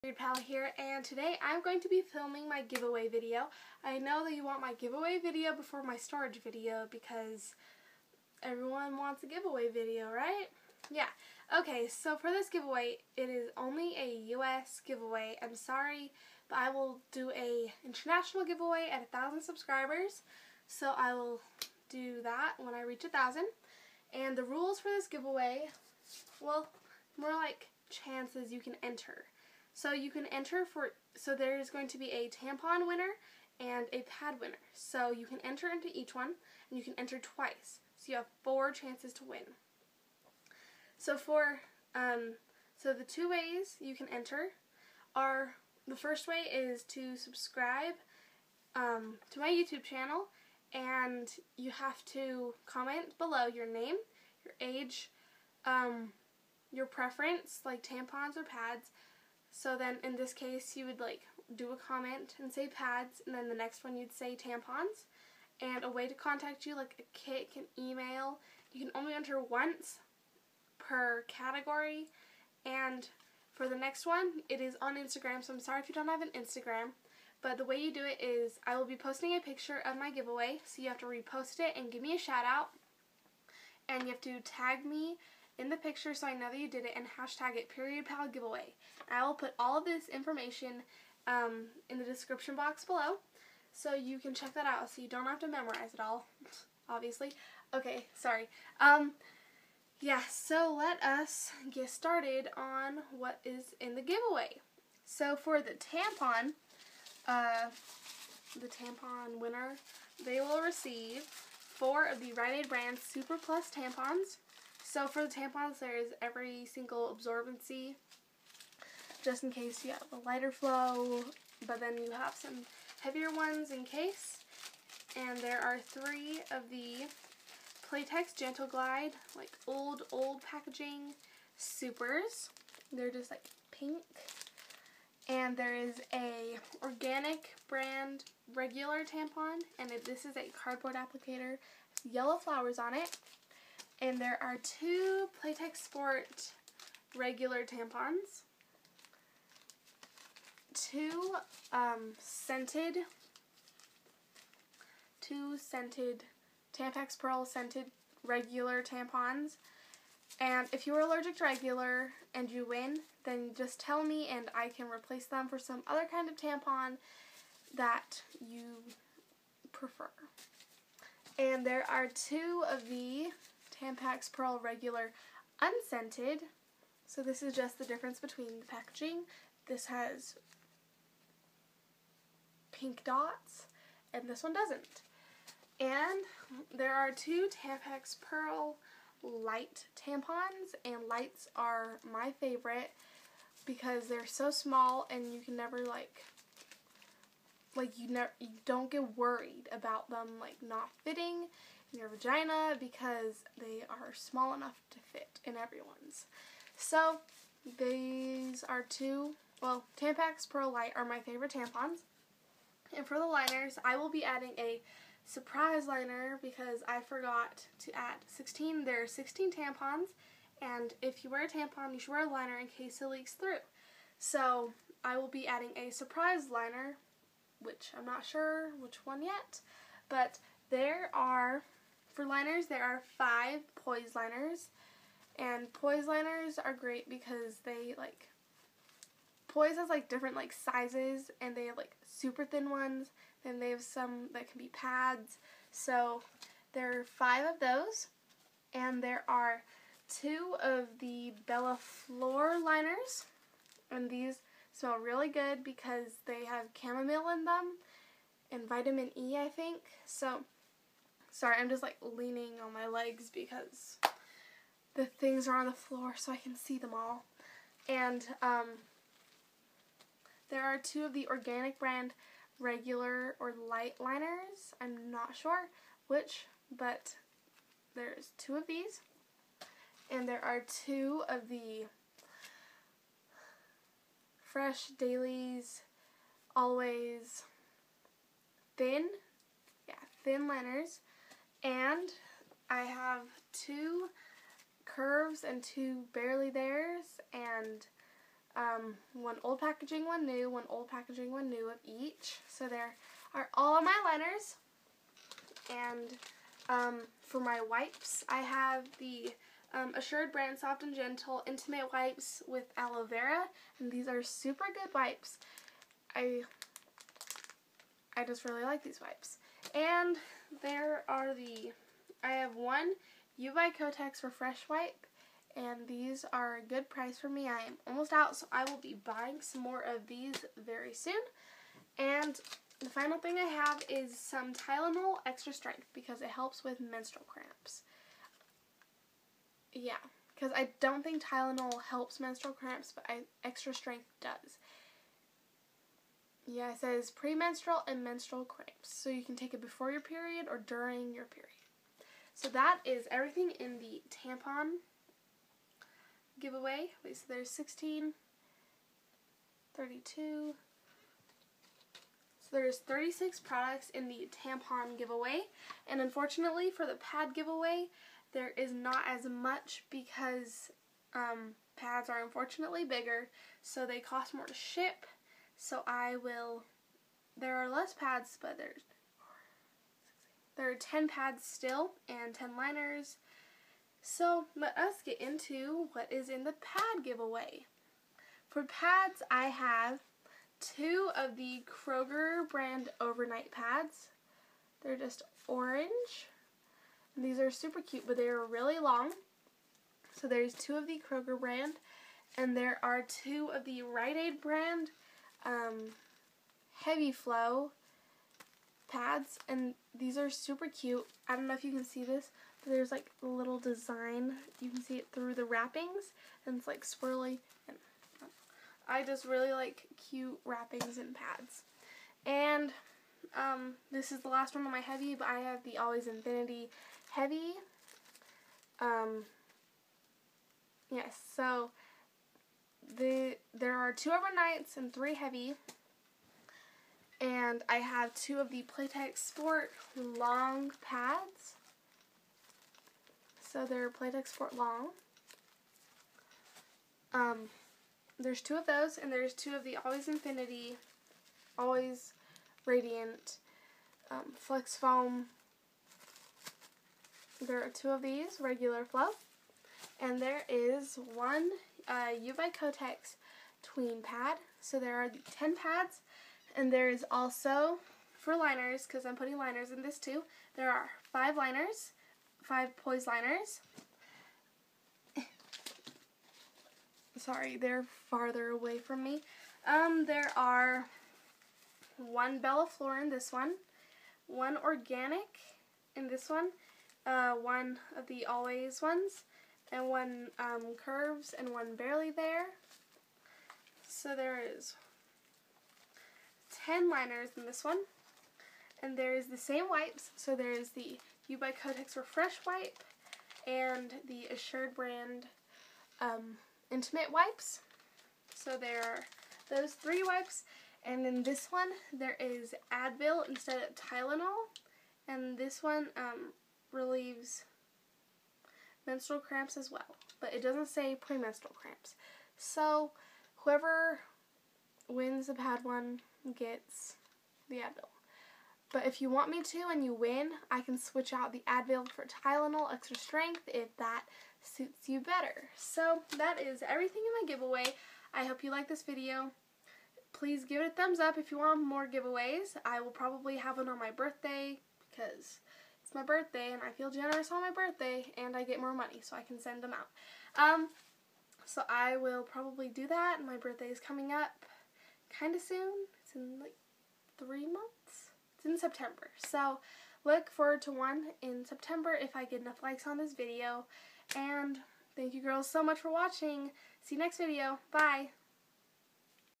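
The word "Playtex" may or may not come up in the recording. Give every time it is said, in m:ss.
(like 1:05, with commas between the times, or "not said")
2:07, 2:25, 7:18, 7:23.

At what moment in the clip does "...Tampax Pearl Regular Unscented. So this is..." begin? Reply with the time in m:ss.
2:53.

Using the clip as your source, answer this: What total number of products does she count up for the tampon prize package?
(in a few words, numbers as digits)
36.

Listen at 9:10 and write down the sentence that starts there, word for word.
Um, so I will probably do that.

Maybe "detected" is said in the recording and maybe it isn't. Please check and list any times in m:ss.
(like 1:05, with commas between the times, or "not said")
not said.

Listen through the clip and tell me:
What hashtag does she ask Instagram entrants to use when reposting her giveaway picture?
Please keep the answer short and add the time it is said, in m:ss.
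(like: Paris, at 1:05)
period pal giveaway, at 1:27.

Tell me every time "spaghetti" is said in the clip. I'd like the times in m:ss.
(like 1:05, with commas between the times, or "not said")
not said.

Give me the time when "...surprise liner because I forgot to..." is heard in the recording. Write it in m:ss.
3:35.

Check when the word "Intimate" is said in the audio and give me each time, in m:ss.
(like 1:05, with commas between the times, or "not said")
5:11, 8:26.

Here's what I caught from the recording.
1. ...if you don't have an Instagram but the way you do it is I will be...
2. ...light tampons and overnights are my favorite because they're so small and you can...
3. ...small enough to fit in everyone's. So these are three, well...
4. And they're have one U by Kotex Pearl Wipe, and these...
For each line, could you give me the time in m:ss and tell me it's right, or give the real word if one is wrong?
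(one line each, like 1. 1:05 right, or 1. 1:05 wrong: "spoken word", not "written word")
1. 1:15 right
2. 3:09 wrong: "lights", not "overnights"
3. 3:24 wrong: "two", not "three"
4. 5:19 wrong: "Refresh", not "Pearl".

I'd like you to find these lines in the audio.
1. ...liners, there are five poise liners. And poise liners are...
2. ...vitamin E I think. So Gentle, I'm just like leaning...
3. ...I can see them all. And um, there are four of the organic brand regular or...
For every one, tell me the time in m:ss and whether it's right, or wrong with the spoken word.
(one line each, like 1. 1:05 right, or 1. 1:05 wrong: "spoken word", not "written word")
1. 3:52 right
2. 4:18 wrong: "Sorry", not "Gentle"
3. 4:26 wrong: "two", not "four".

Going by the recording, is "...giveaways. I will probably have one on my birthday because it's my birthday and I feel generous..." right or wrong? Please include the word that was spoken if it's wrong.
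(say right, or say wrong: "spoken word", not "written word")
right.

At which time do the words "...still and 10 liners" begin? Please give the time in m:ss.
6:21.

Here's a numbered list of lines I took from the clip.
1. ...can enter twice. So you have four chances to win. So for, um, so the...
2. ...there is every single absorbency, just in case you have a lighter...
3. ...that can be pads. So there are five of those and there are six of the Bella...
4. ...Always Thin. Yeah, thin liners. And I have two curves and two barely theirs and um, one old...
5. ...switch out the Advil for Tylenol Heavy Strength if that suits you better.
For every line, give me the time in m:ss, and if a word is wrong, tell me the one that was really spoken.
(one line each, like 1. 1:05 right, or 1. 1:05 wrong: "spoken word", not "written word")
1. 0:36 right
2. 1:55 right
3. 4:04 wrong: "two", not "six"
4. 4:46 right
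5. 8:50 wrong: "Extra", not "Heavy".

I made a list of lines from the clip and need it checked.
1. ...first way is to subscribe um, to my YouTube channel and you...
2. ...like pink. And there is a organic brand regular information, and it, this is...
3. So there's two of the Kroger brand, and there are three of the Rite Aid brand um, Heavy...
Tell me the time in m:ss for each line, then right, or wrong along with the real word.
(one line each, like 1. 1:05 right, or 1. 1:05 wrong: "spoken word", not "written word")
1. 0:45 right
2. 2:13 wrong: "tampon", not "information"
3. 6:40 wrong: "two", not "three".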